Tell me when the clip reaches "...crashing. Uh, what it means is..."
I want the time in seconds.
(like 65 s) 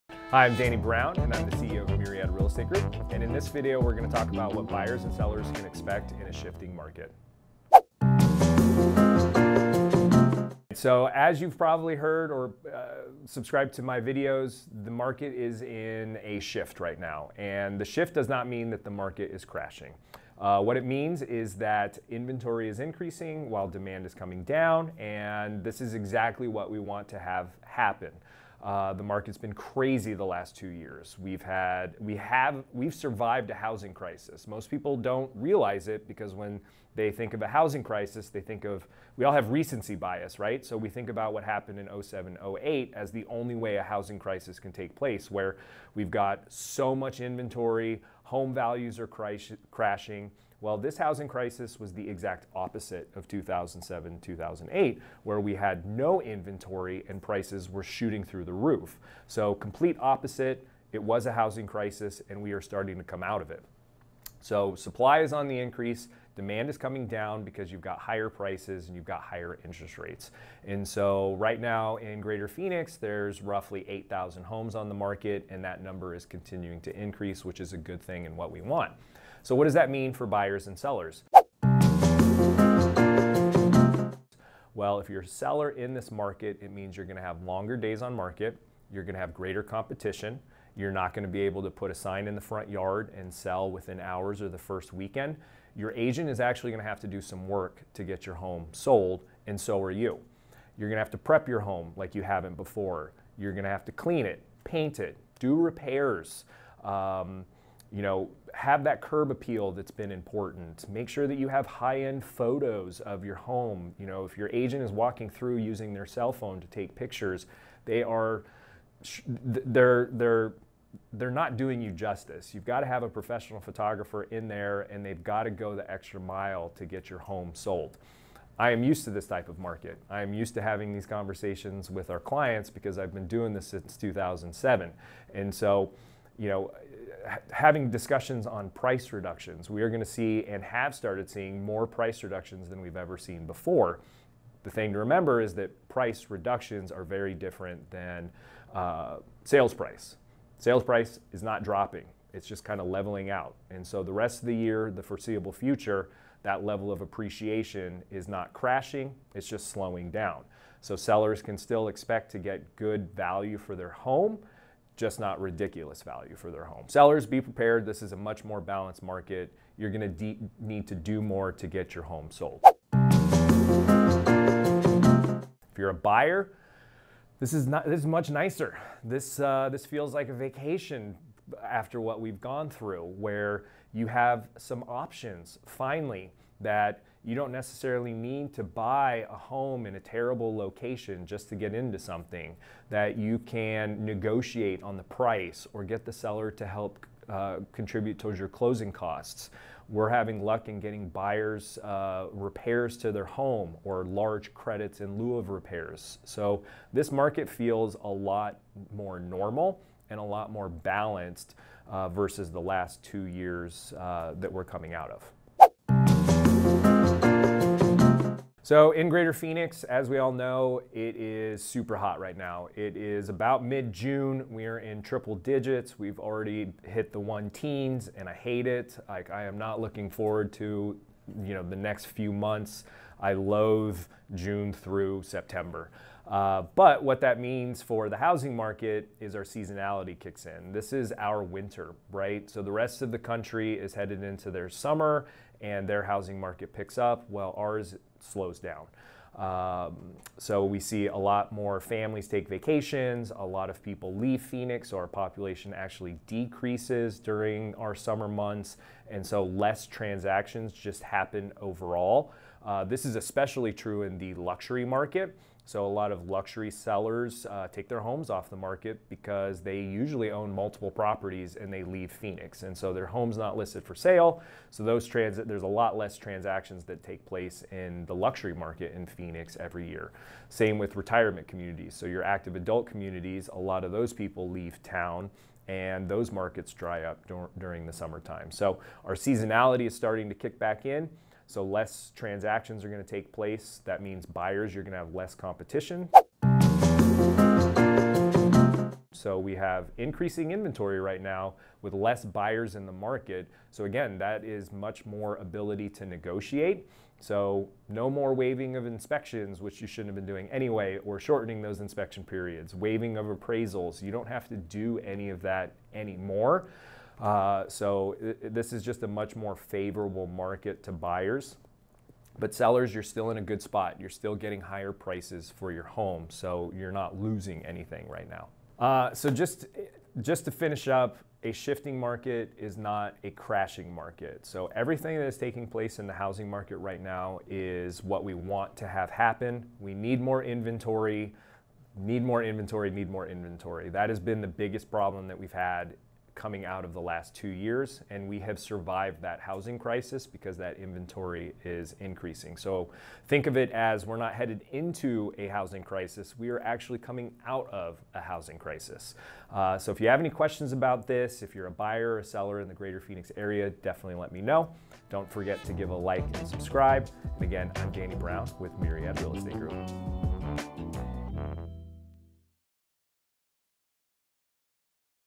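19 s.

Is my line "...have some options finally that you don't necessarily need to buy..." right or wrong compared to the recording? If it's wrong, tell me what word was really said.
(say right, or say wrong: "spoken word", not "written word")
right.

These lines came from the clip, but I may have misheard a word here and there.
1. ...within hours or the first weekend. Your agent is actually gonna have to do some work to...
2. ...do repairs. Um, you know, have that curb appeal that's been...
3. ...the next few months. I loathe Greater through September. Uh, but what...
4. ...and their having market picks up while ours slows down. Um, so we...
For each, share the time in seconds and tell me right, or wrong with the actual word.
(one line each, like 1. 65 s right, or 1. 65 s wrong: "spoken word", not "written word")
1. 93 s right
2. 105 s right
3. 231 s wrong: "June", not "Greater"
4. 245 s wrong: "housing", not "having".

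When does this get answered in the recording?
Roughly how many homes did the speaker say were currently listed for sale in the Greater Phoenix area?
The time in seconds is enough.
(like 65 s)
73 s.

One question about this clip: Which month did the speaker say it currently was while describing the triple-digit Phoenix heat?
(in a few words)
June.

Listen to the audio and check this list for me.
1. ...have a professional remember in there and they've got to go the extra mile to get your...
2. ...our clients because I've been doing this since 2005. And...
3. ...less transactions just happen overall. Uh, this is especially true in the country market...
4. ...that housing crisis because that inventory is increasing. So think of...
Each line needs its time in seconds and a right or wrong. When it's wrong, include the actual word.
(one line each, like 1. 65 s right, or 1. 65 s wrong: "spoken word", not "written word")
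1. 122 s wrong: "photographer", not "remember"
2. 132 s wrong: "2007", not "2005"
3. 259 s wrong: "luxury", not "country"
4. 349 s right.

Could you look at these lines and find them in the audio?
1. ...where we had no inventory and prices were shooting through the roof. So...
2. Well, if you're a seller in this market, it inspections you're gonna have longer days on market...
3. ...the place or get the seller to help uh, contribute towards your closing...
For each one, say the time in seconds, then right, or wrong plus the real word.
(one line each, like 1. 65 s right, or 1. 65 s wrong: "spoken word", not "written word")
1. 55 s right
2. 84 s wrong: "means", not "inspections"
3. 194 s wrong: "price", not "place".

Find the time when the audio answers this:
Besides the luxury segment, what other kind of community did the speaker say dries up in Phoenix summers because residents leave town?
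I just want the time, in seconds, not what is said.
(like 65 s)
280 s.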